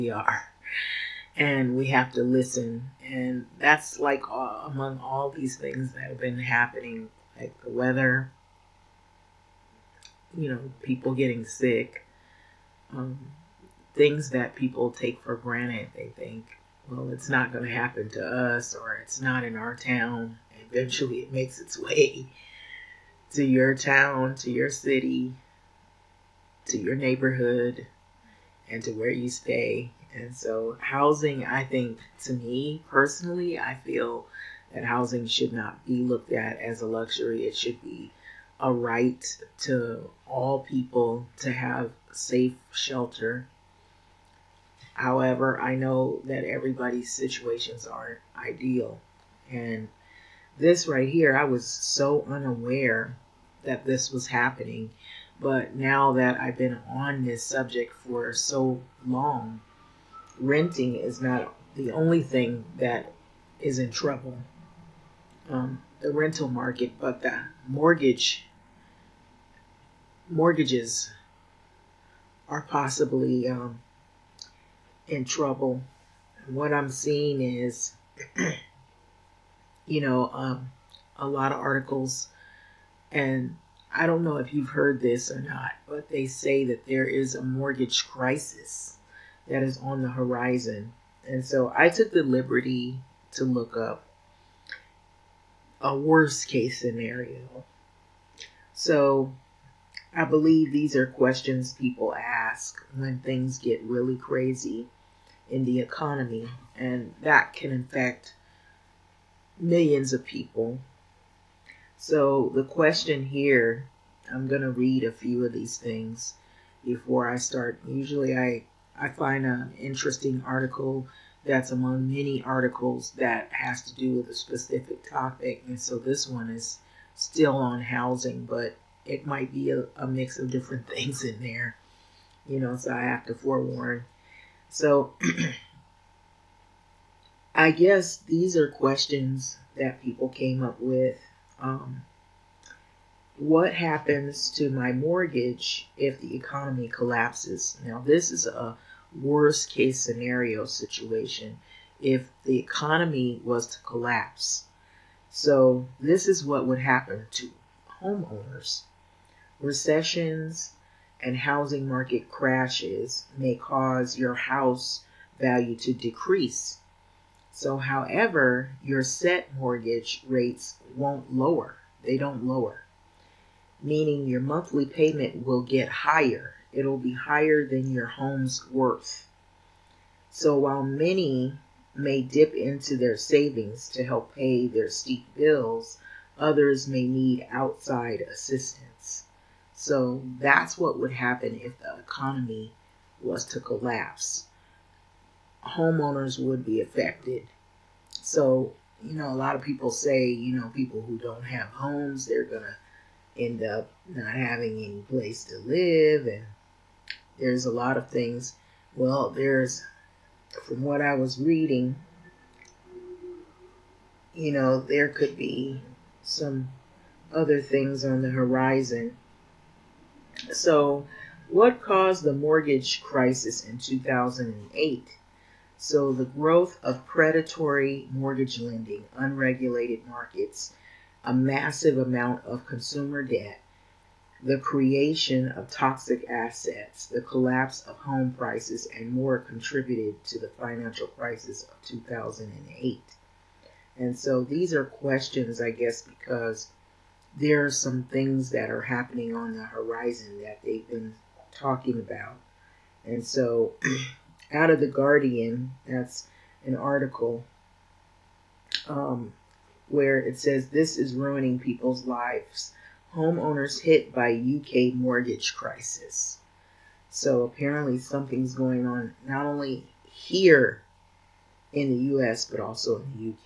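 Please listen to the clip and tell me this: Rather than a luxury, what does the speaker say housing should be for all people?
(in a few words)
A right.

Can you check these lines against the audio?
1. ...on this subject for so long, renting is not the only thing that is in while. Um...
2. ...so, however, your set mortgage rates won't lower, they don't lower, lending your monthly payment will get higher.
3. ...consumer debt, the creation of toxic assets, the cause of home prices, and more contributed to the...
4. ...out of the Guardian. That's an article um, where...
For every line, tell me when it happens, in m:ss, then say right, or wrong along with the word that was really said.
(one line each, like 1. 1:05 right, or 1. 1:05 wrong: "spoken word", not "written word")
1. 0:56 wrong: "trouble", not "while"
2. 2:47 wrong: "meaning", not "lending"
3. 3:52 wrong: "collapse", not "cause"
4. 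4:14 right.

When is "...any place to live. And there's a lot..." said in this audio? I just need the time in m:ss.
3:24.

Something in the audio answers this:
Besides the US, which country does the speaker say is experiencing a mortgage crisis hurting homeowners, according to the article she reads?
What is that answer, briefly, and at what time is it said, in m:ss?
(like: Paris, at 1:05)
UK, at 4:24.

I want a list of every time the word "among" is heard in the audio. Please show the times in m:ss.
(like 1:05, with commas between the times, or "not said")
0:04, 2:01.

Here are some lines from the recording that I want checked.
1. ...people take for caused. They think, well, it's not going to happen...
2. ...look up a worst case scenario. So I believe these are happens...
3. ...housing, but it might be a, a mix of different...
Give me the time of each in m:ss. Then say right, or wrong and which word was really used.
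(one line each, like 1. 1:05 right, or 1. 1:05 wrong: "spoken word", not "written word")
1. 0:14 wrong: "granted", not "caused"
2. 1:33 wrong: "questions", not "happens"
3. 2:07 right.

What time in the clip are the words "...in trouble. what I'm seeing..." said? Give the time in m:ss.
1:15.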